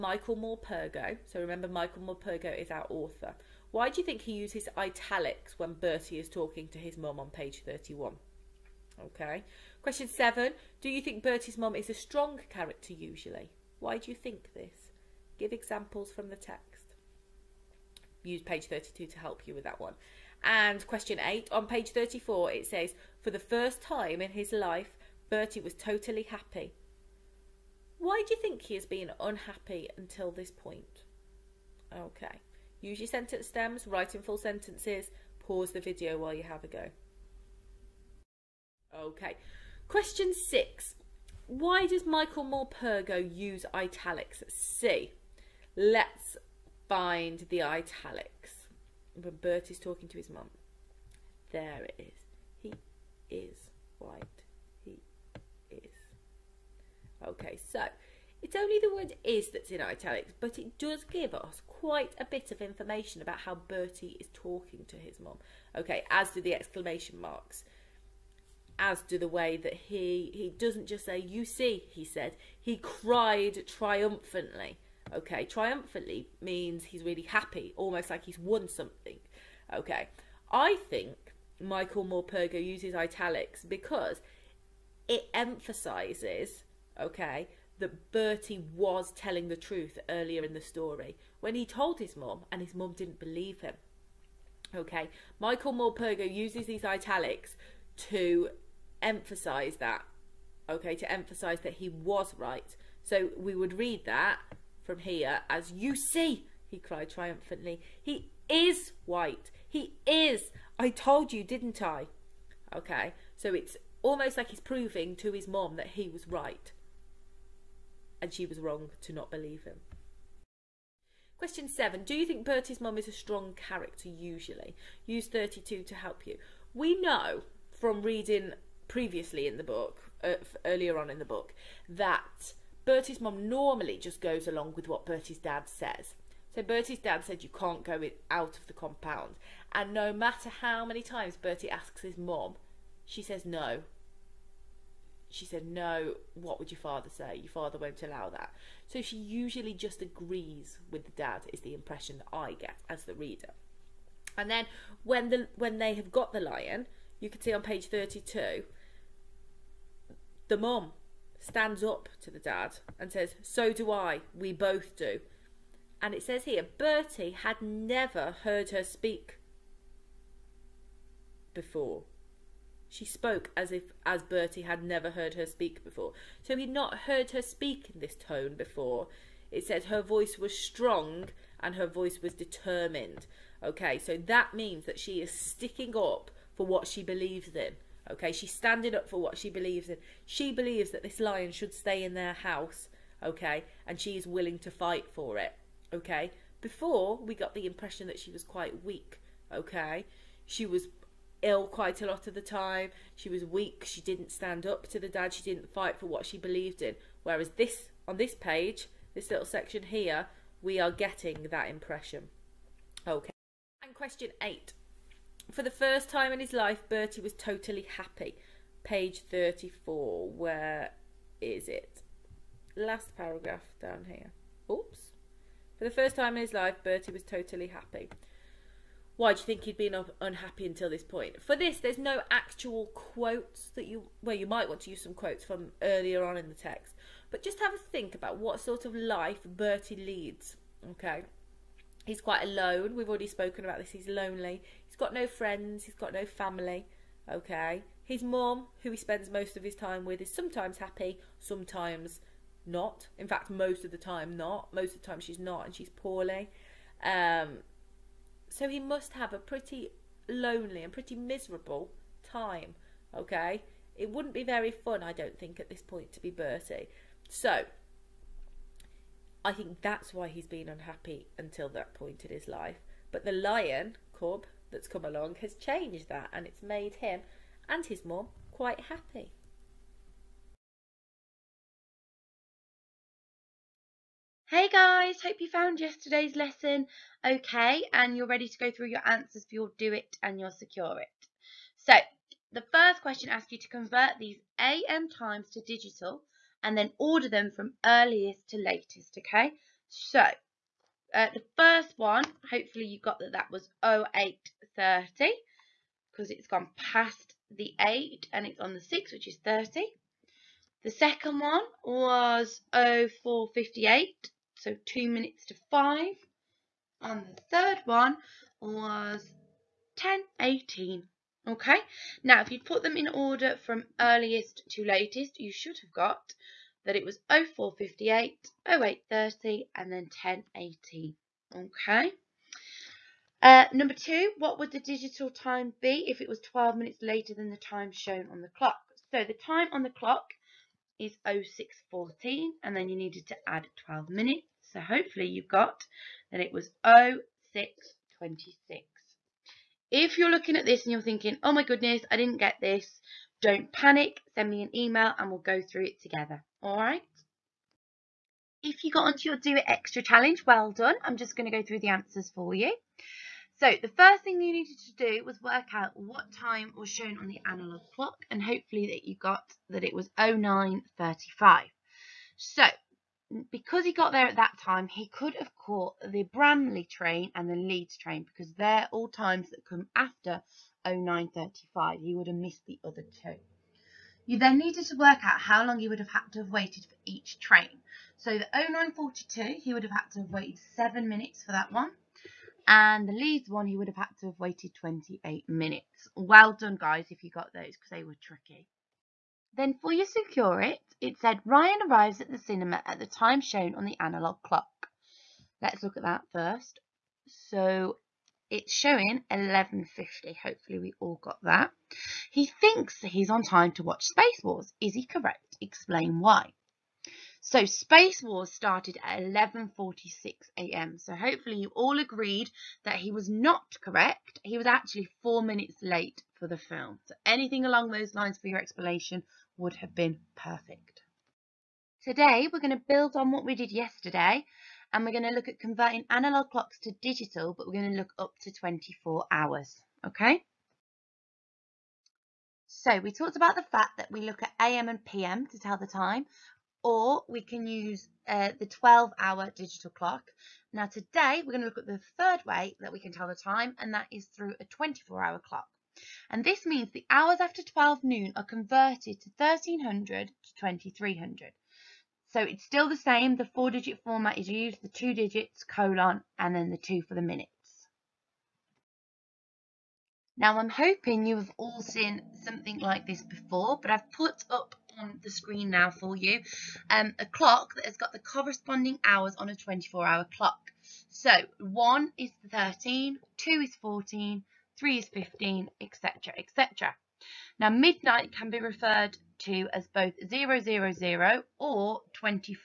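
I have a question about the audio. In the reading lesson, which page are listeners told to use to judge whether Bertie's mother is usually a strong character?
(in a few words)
32.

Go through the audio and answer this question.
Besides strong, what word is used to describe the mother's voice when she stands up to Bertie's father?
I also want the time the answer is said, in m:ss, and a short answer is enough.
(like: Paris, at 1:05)
Determined, at 3:02.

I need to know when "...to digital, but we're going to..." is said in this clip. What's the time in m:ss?
7:16.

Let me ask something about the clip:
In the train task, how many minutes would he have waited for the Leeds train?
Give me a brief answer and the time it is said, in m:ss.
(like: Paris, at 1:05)
28 minutes, at 6:34.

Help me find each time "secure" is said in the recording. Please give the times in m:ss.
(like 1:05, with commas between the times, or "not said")
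4:50, 6:40.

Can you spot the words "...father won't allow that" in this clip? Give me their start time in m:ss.
2:27.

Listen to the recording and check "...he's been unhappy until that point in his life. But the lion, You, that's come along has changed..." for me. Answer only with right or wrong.
wrong.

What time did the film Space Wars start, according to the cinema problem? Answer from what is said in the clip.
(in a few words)
11:46 a.m.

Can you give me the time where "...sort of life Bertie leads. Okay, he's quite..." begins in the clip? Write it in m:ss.
3:58.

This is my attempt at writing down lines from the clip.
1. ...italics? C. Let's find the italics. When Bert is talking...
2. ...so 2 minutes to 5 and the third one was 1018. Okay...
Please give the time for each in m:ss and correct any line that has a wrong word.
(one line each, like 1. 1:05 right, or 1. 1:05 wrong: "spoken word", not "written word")
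1. 0:43 right
2. 5:14 right.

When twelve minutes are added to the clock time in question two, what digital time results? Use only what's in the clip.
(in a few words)
06:26.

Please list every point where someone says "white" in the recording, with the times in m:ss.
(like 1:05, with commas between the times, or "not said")
0:53, 1:49.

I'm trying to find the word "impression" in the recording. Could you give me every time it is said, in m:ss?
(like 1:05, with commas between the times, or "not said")
2:31, 3:17, 3:31.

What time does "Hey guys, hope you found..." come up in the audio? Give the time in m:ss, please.
4:44.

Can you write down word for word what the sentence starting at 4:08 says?
His mum, who he spends most of his time with, is sometimes happy, sometimes not.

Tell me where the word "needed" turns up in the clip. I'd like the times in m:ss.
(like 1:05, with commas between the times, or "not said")
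5:42, 6:04, 6:24.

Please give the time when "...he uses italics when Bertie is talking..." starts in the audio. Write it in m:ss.
0:04.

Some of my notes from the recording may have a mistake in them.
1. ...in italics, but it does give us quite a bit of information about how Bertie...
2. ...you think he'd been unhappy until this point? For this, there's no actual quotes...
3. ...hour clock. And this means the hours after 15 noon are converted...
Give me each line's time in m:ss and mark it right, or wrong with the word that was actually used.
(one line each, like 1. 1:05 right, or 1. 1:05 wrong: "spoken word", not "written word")
1. 0:59 right
2. 3:49 right
3. 7:35 wrong: "12", not "15".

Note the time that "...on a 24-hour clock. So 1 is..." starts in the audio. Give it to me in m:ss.
7:59.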